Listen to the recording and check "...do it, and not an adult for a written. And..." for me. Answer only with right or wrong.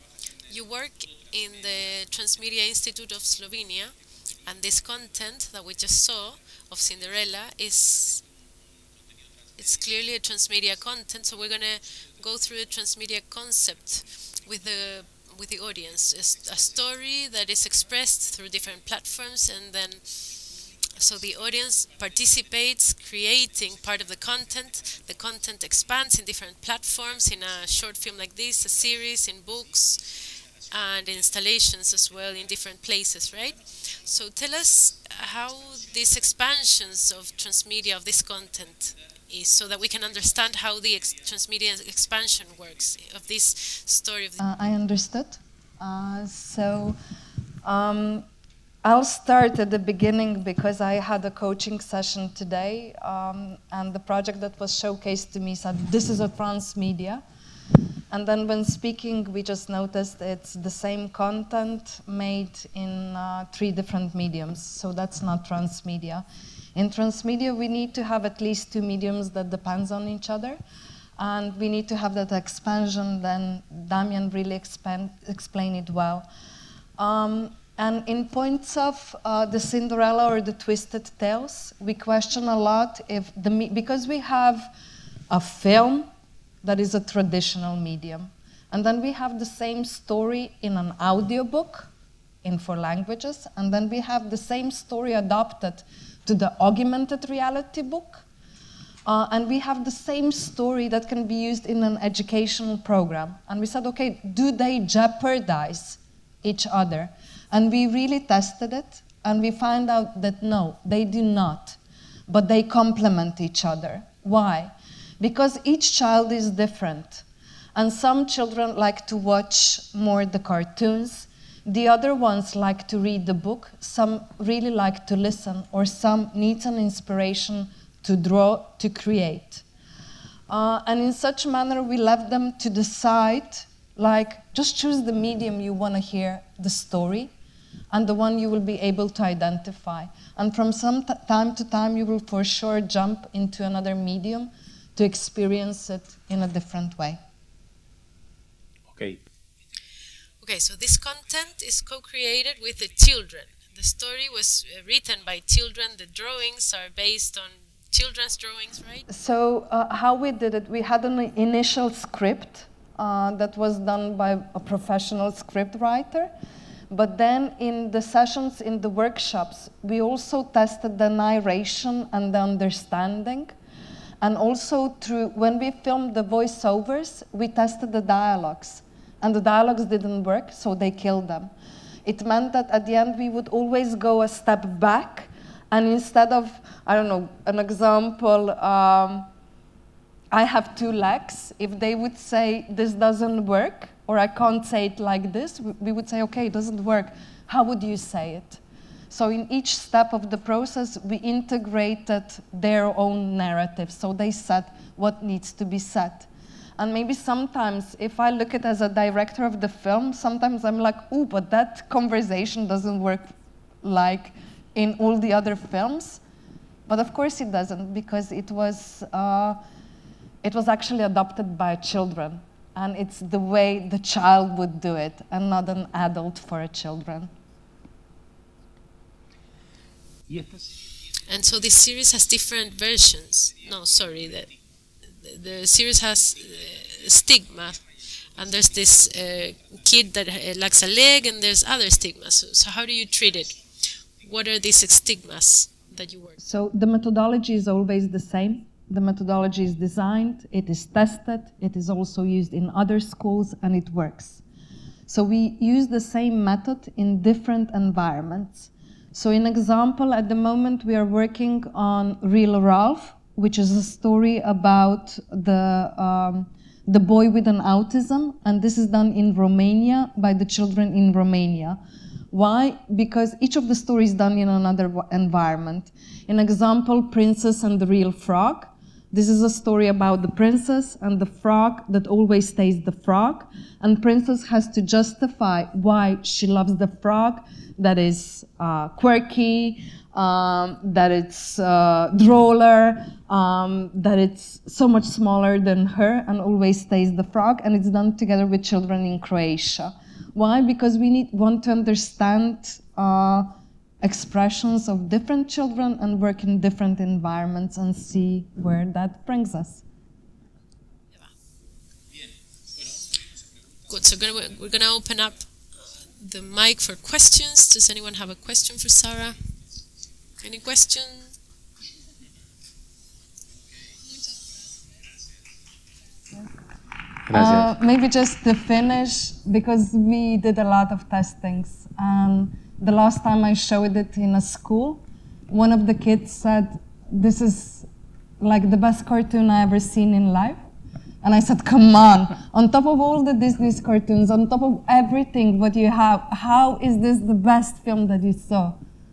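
wrong.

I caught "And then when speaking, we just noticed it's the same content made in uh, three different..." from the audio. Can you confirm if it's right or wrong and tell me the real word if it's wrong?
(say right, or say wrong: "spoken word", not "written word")
right.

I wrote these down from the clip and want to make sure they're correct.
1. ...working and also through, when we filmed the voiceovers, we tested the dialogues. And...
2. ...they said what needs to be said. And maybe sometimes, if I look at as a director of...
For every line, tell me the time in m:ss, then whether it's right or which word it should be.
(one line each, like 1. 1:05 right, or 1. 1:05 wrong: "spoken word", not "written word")
1. 2:52 wrong: "understanding", not "working"
2. 3:24 right.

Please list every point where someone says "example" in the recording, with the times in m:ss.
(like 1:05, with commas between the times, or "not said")
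3:07, 4:19, 4:36.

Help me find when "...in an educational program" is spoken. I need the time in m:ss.
1:41.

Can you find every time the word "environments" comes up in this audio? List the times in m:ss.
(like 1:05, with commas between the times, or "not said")
4:17, 4:35, 5:07.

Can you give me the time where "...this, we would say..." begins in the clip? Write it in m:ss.
3:15.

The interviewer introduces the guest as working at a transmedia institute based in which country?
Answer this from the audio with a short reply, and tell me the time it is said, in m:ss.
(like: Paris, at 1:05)
Slovenia, at 0:03.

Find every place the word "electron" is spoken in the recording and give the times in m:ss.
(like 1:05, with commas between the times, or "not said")
not said.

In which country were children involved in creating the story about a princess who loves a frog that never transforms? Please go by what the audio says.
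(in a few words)
Croatia.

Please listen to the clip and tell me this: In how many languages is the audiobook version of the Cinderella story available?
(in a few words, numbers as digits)
4.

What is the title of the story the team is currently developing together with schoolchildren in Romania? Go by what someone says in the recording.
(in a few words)
Real Ralph.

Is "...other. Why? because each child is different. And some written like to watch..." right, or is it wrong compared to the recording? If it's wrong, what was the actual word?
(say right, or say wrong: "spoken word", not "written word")
wrong: "children", not "written".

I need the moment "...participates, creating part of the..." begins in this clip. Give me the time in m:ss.
0:21.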